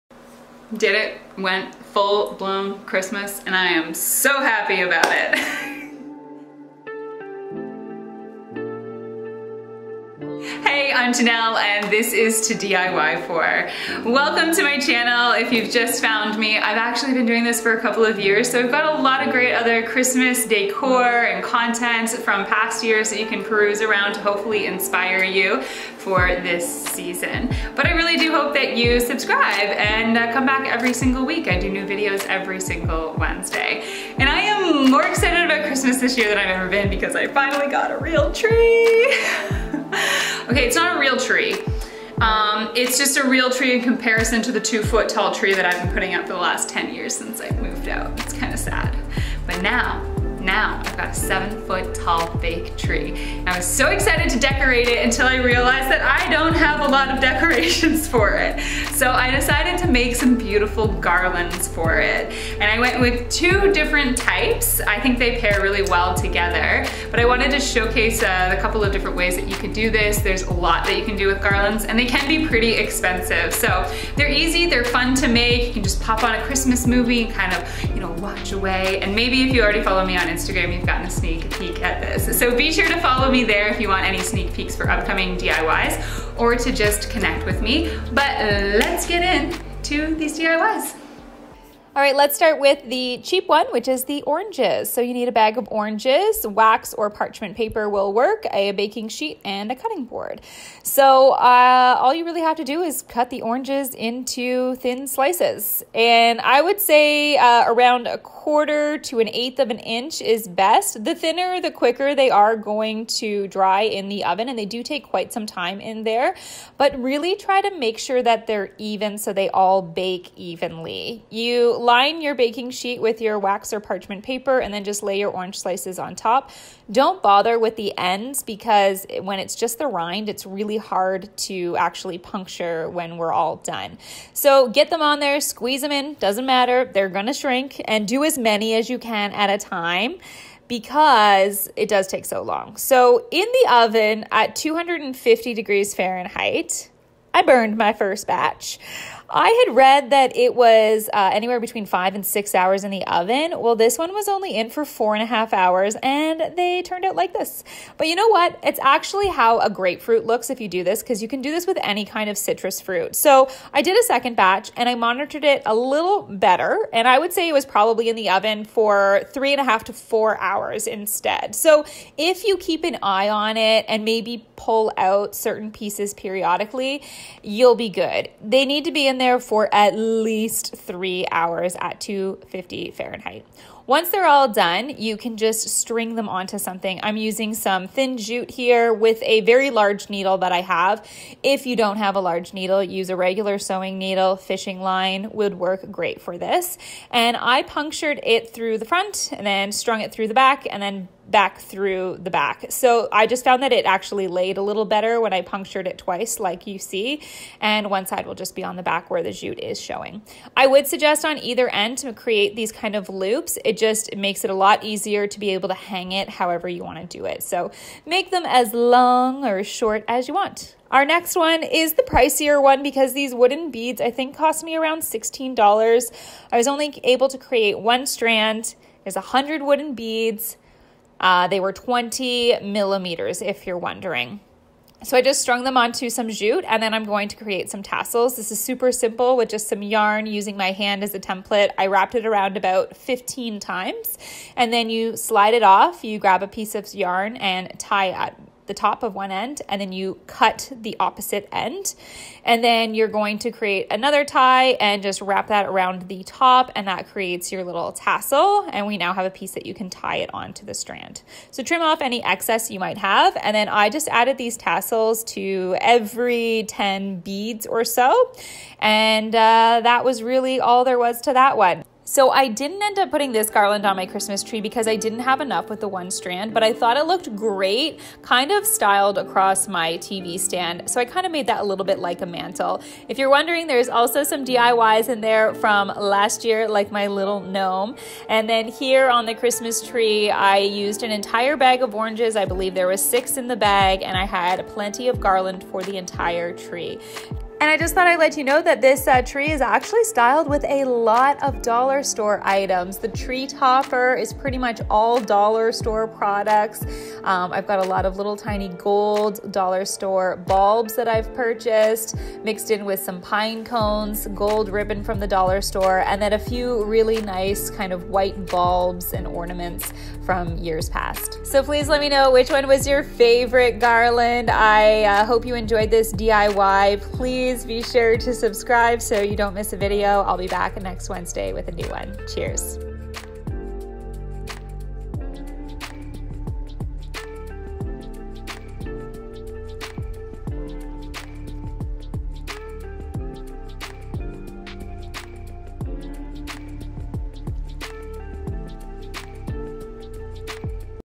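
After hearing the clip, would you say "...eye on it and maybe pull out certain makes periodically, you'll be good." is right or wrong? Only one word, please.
wrong.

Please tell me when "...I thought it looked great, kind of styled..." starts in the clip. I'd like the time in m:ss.
4:36.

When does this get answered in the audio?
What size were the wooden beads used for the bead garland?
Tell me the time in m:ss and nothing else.
3:51.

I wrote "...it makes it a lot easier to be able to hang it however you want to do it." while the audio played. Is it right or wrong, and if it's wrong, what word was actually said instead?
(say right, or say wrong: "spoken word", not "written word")
right.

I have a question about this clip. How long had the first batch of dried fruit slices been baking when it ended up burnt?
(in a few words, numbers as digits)
4.5 hours.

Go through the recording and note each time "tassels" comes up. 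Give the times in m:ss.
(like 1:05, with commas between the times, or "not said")
3:57, 4:17, 4:24.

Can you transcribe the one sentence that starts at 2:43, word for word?
So I did a second batch and I monitored it a little better.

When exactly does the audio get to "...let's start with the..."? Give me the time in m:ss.
1:32.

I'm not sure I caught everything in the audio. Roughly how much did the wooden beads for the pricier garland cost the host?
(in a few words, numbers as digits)
$16.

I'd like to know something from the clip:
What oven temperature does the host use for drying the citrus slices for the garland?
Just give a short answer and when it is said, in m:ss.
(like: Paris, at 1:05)
250 degrees Fahrenheit, at 2:24.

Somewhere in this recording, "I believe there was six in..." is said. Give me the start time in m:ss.
4:52.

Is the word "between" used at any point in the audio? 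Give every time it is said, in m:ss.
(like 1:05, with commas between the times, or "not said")
2:31.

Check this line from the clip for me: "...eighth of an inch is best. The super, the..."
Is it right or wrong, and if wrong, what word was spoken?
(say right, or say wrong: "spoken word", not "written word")
wrong: "thinner", not "super".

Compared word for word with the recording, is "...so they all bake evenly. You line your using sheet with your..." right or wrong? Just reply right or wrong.
wrong.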